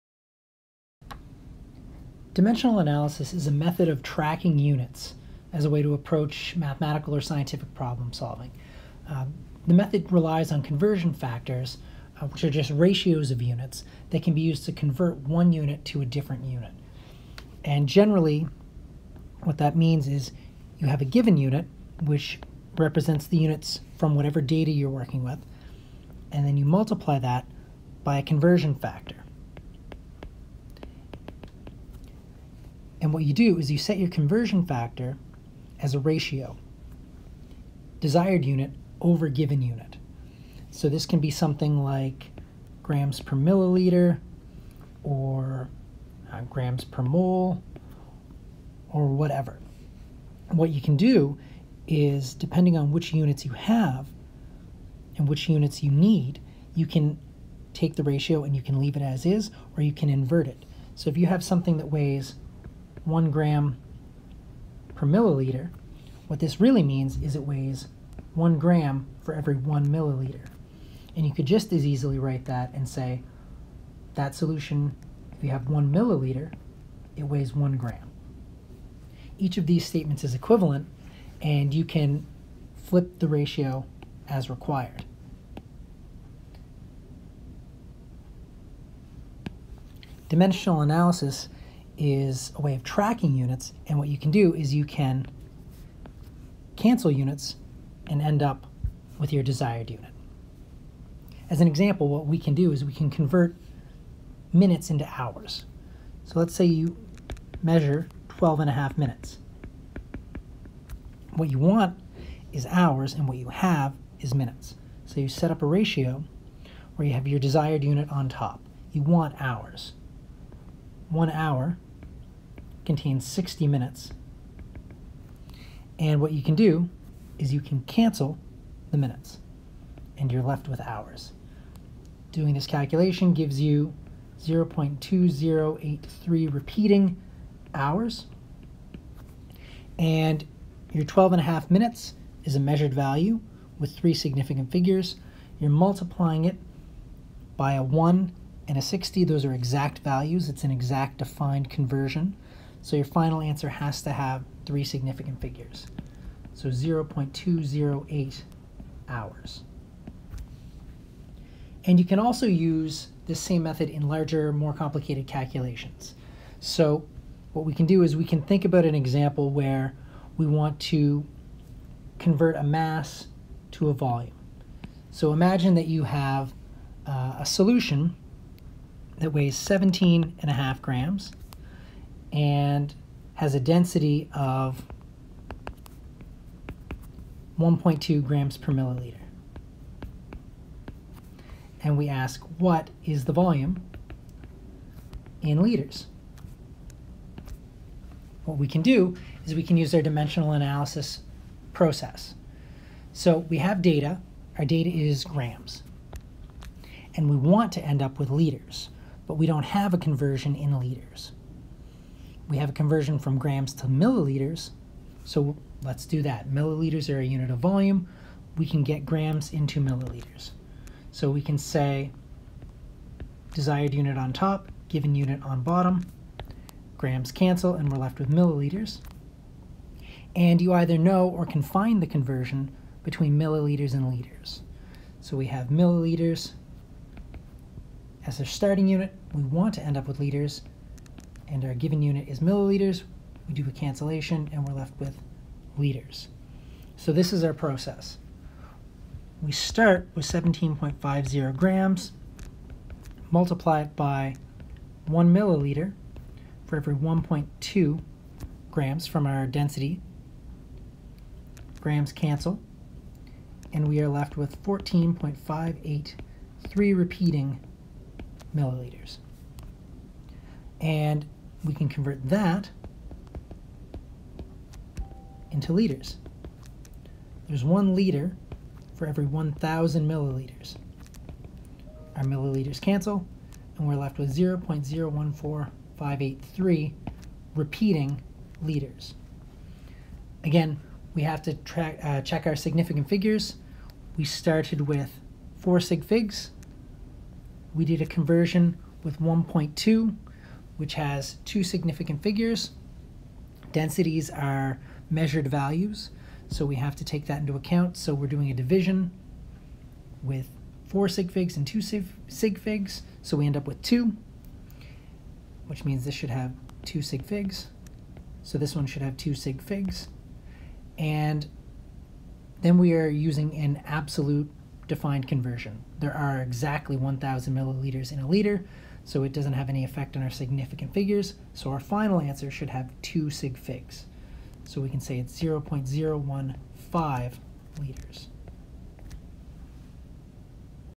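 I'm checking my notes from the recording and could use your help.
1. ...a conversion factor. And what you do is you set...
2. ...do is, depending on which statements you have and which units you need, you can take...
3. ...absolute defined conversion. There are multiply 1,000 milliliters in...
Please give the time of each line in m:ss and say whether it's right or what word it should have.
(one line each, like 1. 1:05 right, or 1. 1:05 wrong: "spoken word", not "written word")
1. 0:28 right
2. 0:50 wrong: "units", not "statements"
3. 5:23 wrong: "exactly", not "multiply".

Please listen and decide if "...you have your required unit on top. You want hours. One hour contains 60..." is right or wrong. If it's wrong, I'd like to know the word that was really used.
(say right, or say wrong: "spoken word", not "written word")
wrong: "desired", not "required".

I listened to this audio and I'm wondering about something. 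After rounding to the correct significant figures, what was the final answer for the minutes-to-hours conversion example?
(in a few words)
0.208 hours.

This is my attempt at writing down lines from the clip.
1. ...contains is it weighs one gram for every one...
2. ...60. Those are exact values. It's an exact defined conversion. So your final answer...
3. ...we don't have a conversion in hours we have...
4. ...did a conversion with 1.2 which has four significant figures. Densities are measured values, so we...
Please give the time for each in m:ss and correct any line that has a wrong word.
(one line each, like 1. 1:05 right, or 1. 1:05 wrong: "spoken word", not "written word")
1. 1:06 wrong: "means", not "contains"
2. 2:28 right
3. 3:29 wrong: "liters", not "hours"
4. 4:57 wrong: "two", not "four".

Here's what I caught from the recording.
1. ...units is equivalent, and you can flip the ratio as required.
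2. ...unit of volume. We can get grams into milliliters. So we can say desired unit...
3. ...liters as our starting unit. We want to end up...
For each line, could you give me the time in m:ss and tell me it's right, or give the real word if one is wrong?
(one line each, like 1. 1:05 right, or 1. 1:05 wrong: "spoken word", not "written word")
1. 1:19 wrong: "statements", not "units"
2. 3:37 right
3. 3:55 wrong: "milliliters", not "liters".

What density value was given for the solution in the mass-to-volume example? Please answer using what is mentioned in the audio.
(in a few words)
1.2 grams per milliliter.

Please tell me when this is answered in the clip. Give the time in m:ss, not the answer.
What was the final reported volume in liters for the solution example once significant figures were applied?
5:35.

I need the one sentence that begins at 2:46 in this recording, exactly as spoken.
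So what we can do is we can think about an example where we want to convert a mass to a volume.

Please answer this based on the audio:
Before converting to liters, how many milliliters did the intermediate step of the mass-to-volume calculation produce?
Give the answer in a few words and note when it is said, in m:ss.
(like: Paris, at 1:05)
14.583 repeating milliliters, at 4:24.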